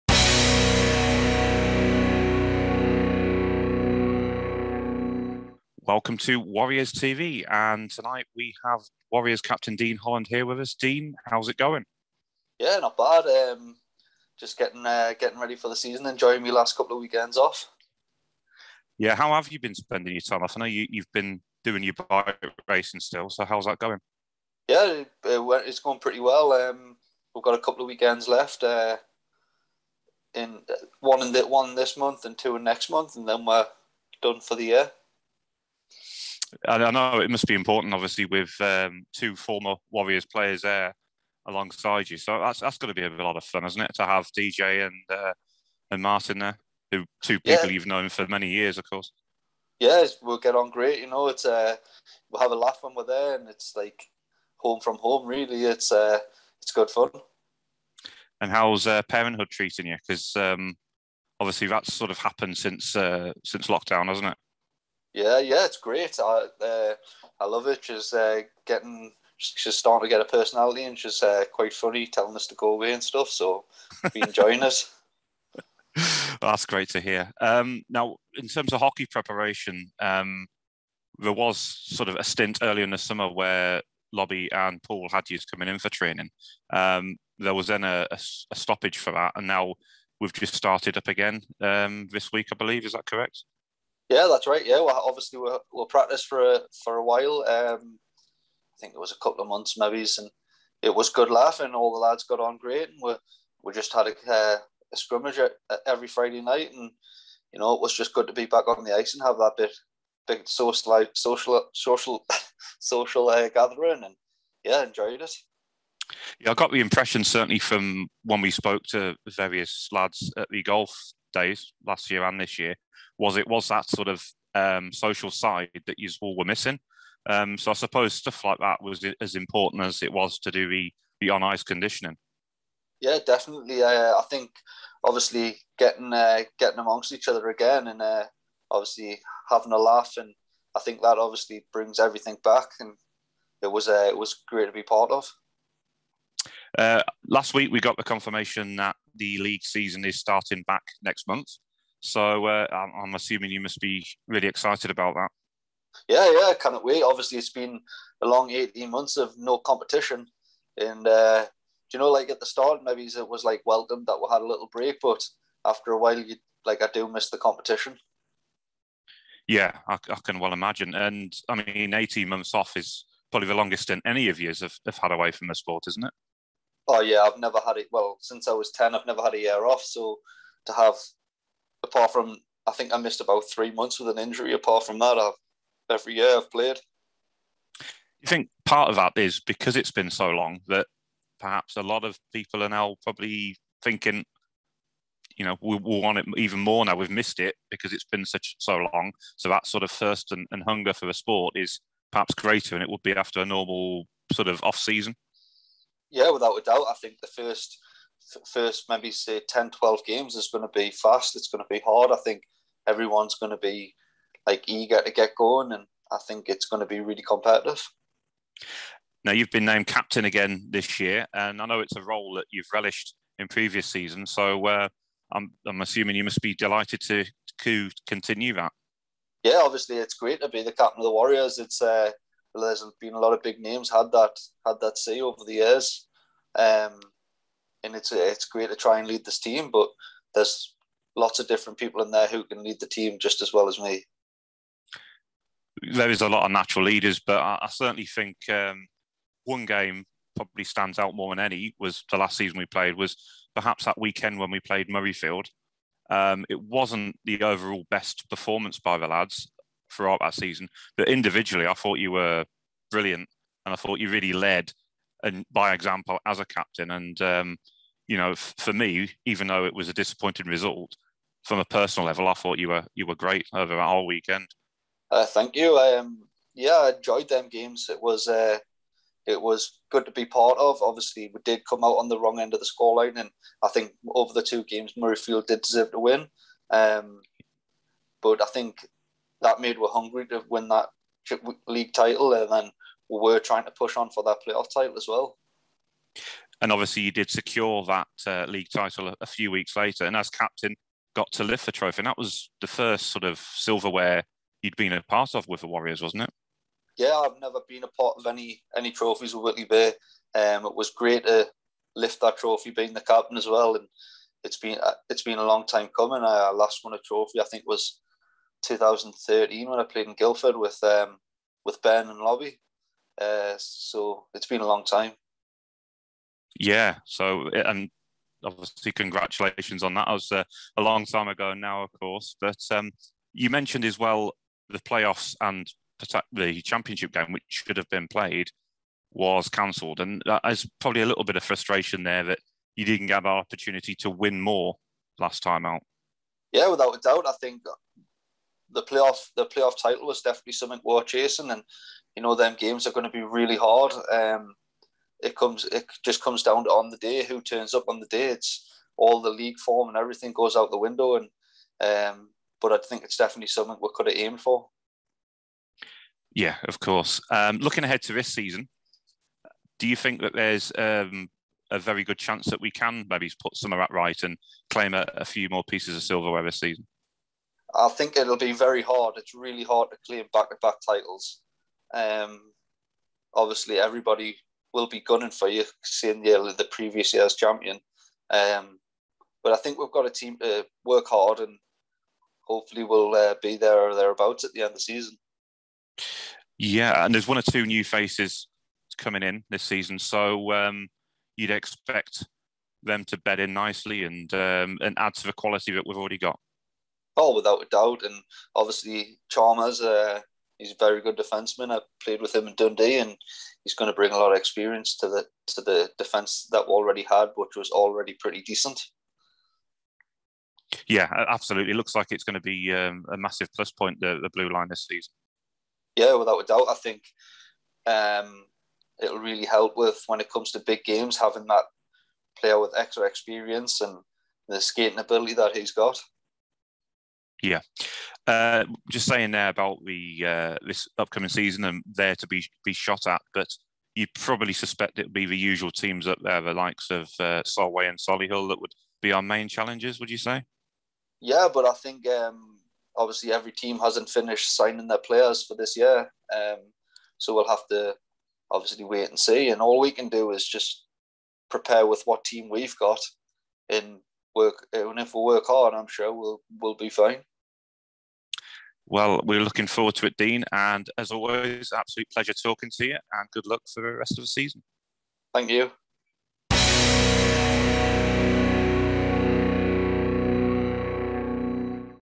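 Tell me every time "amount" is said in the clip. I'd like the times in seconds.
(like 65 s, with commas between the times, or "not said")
not said.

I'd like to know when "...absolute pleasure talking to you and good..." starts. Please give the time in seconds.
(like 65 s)
471 s.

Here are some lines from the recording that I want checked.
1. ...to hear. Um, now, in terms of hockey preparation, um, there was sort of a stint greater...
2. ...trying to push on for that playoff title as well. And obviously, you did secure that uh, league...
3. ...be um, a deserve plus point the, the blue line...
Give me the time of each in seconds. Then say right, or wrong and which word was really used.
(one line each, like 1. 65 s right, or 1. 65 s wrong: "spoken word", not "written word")
1. 76 s wrong: "earlier", not "greater"
2. 293 s right
3. 422 s wrong: "massive", not "deserve".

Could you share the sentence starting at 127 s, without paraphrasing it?
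Um, so I suppose stuff like that was as important as it was to do the, the on ice conditioning.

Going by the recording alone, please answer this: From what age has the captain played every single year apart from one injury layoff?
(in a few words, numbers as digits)
10.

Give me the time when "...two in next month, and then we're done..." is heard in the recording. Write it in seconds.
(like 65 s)
32 s.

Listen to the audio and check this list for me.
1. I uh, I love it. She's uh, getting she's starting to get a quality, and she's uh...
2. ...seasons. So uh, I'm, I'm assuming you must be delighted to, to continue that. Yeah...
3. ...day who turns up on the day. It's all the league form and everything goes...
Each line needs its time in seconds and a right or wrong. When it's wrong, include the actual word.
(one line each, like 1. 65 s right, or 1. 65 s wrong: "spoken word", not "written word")
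1. 66 s wrong: "personality", not "quality"
2. 223 s right
3. 356 s right.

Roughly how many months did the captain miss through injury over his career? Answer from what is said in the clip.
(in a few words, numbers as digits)
3 months.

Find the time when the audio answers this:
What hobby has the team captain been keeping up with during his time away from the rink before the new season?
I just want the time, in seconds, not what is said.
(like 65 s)
22 s.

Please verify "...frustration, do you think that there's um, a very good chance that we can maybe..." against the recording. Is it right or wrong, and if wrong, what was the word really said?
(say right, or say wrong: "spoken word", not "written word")
wrong: "season", not "frustration".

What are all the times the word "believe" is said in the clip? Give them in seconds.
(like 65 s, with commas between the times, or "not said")
92 s.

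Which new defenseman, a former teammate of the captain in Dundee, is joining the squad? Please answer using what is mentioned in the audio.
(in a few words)
Chalmers.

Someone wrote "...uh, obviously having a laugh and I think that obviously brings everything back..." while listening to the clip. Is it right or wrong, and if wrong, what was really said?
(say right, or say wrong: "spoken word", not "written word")
right.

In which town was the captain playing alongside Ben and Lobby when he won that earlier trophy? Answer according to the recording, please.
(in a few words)
Guildford.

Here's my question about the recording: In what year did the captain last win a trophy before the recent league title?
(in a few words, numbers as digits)
2013.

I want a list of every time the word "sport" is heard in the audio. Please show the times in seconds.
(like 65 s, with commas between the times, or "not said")
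175 s, 201 s.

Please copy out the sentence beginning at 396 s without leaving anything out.
Yeah, and there's one or two new faces coming in this season.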